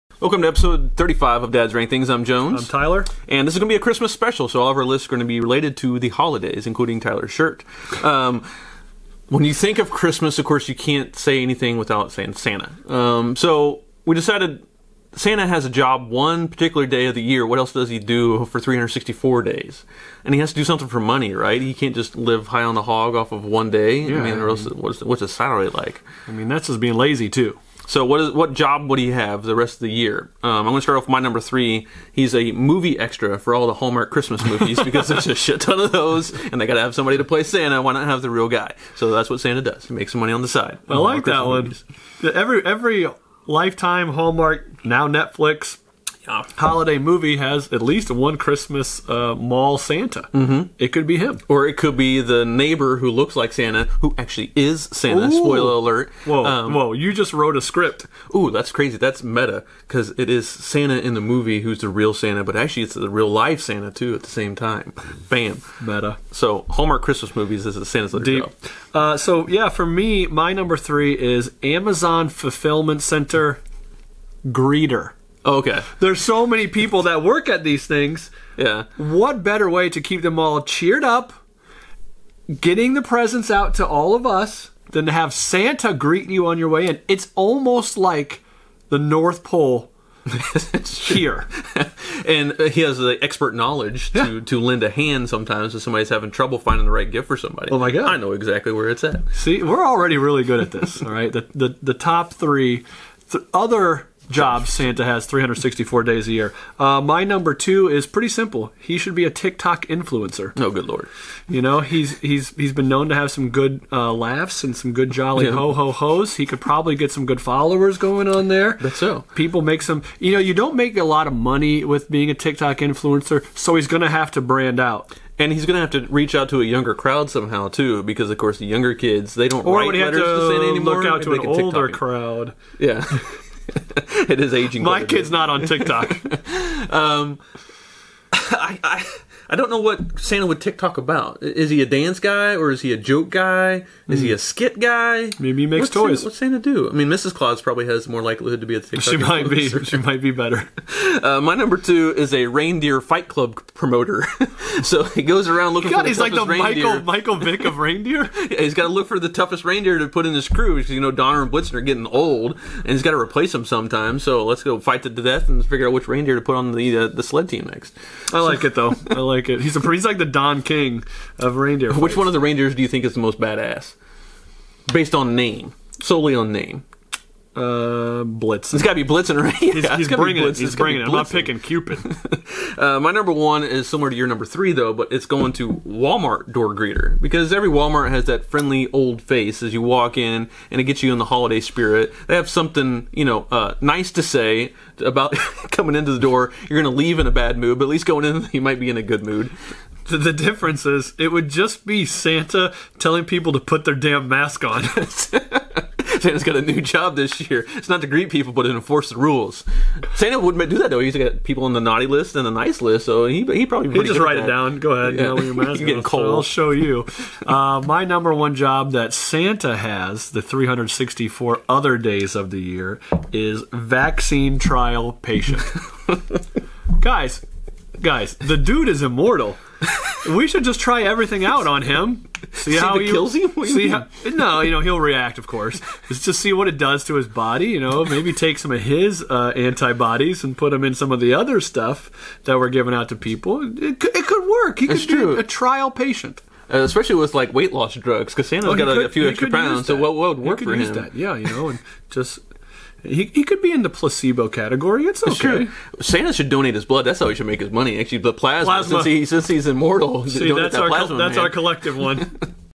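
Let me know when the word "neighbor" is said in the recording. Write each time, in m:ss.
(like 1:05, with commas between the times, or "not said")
0:52.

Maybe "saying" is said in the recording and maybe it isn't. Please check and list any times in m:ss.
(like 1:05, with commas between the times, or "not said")
0:12.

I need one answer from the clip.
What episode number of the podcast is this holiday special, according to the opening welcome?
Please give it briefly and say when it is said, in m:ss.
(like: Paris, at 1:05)
35, at 0:00.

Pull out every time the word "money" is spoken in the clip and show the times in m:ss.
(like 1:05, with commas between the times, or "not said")
0:20, 0:40, 2:01, 4:17.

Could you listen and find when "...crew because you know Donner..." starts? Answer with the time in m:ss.
2:40.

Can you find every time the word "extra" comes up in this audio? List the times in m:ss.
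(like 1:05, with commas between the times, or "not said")
0:32, 4:09.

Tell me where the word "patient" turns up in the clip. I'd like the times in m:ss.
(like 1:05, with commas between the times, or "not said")
3:45, 4:05.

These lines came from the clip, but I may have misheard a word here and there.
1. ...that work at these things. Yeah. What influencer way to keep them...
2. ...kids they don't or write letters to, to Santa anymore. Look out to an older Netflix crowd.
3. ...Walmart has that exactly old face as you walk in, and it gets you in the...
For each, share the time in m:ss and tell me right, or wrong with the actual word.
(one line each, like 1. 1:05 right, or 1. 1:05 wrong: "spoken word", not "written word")
1. 1:17 wrong: "better", not "influencer"
2. 2:08 wrong: "TikTok", not "Netflix"
3. 3:07 wrong: "friendly", not "exactly".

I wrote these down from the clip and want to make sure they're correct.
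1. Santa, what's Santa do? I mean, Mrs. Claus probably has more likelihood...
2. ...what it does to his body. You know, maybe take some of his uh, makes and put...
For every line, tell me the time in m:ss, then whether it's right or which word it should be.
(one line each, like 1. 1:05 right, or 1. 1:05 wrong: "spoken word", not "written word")
1. 2:26 right
2. 3:56 wrong: "antibodies", not "makes".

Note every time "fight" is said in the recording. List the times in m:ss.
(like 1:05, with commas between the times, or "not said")
2:33, 2:44.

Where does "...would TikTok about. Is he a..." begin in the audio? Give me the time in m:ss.
2:20.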